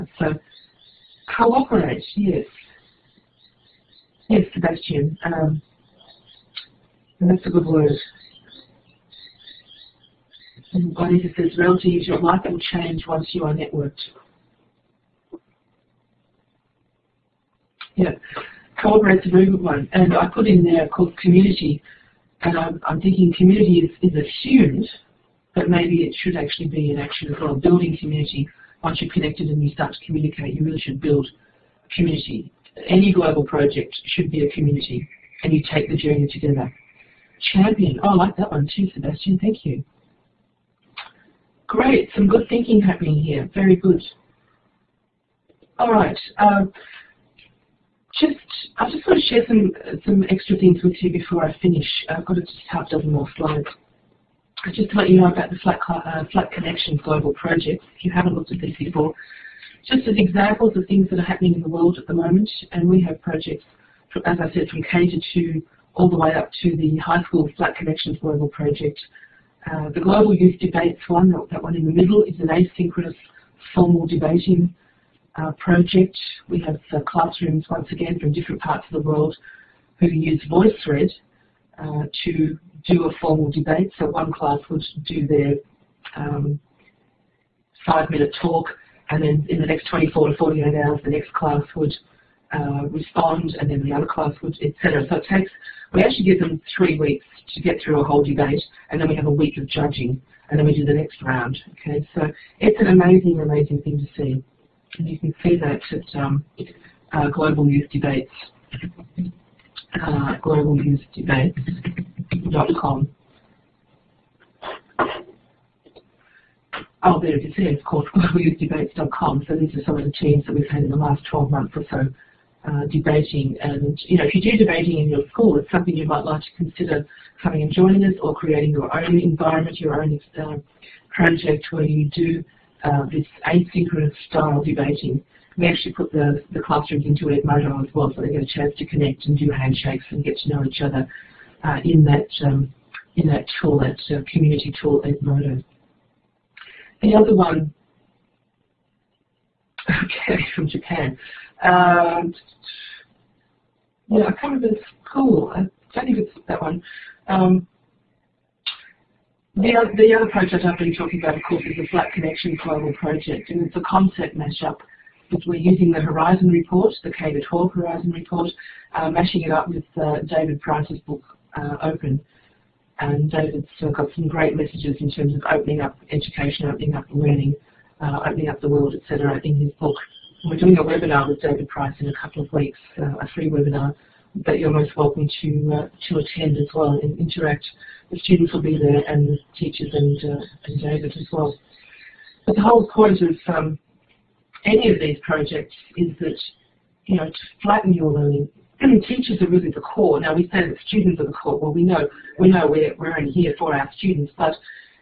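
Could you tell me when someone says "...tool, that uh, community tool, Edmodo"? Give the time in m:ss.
2:23.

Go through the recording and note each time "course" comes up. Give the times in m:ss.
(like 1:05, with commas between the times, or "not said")
1:57, 2:41.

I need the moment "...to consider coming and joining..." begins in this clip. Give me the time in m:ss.
2:06.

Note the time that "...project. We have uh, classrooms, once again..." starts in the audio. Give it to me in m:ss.
1:15.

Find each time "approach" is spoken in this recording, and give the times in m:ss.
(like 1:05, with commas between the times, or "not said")
not said.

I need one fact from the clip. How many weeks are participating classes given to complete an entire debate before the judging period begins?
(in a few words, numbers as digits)
3.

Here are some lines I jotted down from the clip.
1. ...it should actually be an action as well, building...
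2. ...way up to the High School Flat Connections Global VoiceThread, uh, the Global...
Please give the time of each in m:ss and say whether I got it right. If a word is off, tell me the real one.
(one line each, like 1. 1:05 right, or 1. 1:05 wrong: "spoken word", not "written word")
1. 0:26 right
2. 1:06 wrong: "Project", not "VoiceThread".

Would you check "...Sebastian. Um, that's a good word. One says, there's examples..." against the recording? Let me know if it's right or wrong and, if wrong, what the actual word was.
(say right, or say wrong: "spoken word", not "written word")
wrong: "relatives", not "examples".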